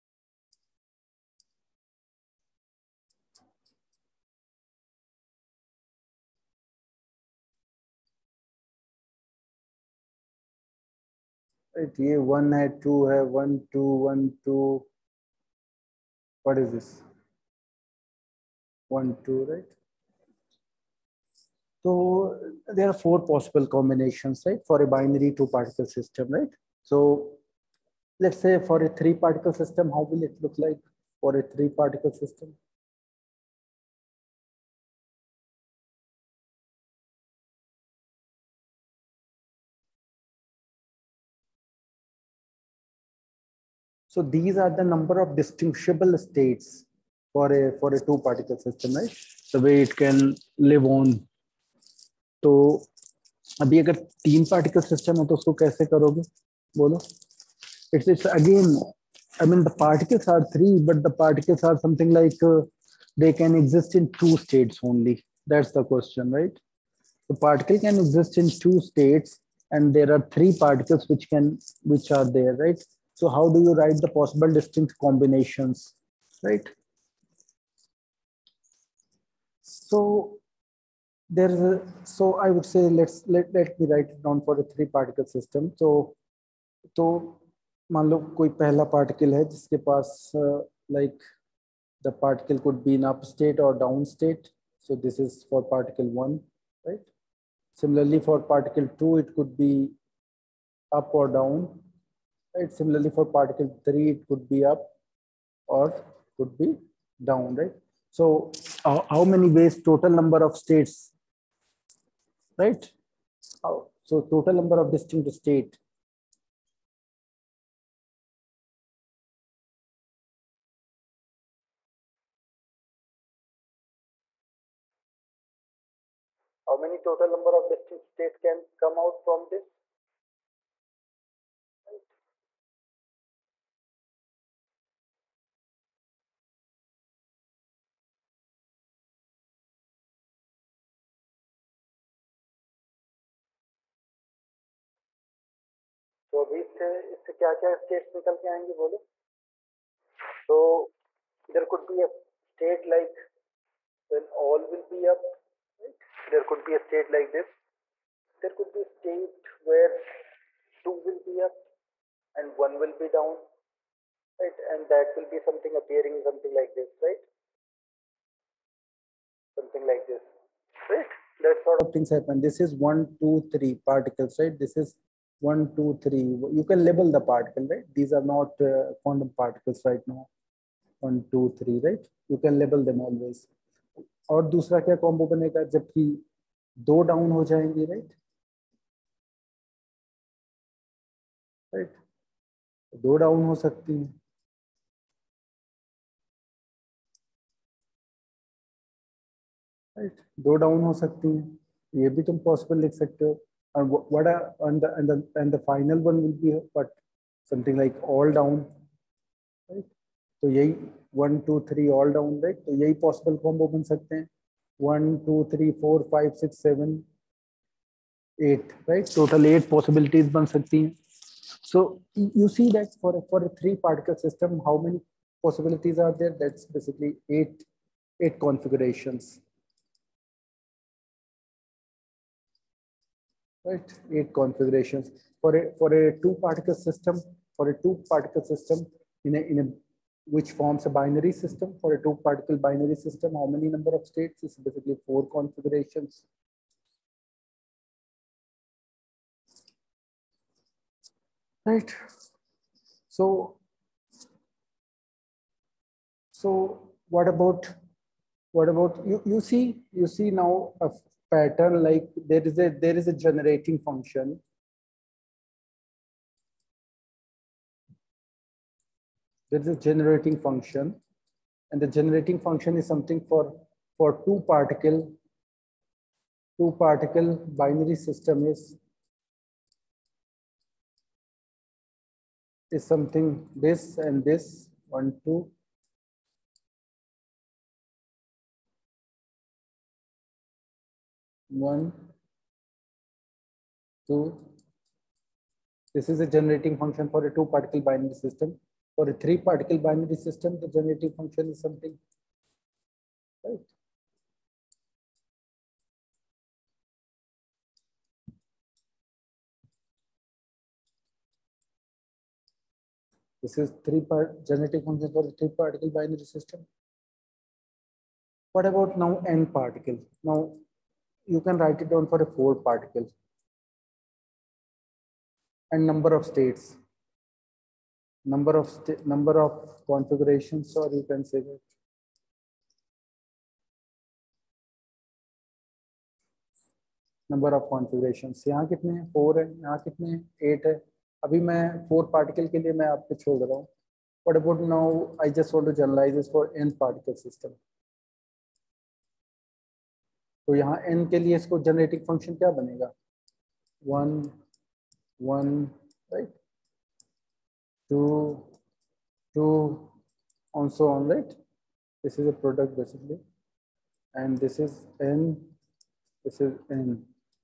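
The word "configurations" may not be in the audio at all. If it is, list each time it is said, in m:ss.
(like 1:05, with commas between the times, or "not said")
3:48, 3:54, 4:05, 5:29.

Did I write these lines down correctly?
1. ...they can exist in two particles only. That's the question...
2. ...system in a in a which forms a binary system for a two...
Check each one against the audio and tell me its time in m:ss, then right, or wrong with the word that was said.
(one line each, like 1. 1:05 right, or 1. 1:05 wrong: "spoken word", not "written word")
1. 1:03 wrong: "states", not "particles"
2. 3:58 right.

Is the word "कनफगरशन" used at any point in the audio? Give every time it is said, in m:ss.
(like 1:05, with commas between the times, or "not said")
5:37.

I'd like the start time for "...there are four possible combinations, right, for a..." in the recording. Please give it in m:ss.
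0:22.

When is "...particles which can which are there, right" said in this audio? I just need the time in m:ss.
1:10.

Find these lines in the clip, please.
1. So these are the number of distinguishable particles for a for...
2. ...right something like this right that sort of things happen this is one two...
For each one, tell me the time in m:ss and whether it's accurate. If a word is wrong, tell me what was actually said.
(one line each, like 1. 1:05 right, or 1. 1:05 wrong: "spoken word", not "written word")
1. 0:44 wrong: "states", not "particles"
2. 2:47 right.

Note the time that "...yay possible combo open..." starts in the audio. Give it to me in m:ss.
3:32.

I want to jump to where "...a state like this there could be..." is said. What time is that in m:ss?
2:36.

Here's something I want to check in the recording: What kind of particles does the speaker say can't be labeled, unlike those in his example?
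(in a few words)
quantum particles.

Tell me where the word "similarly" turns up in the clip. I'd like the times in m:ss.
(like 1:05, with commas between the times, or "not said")
1:37, 1:42.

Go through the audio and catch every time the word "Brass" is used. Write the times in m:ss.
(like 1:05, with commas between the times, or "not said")
not said.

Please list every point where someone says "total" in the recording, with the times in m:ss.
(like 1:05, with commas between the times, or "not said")
1:49, 1:54, 2:06, 3:39.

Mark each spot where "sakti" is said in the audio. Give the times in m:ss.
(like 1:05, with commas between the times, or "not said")
3:40.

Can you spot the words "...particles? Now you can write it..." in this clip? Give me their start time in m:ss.
5:19.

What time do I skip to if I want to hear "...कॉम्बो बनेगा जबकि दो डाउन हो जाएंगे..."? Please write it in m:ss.
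3:04.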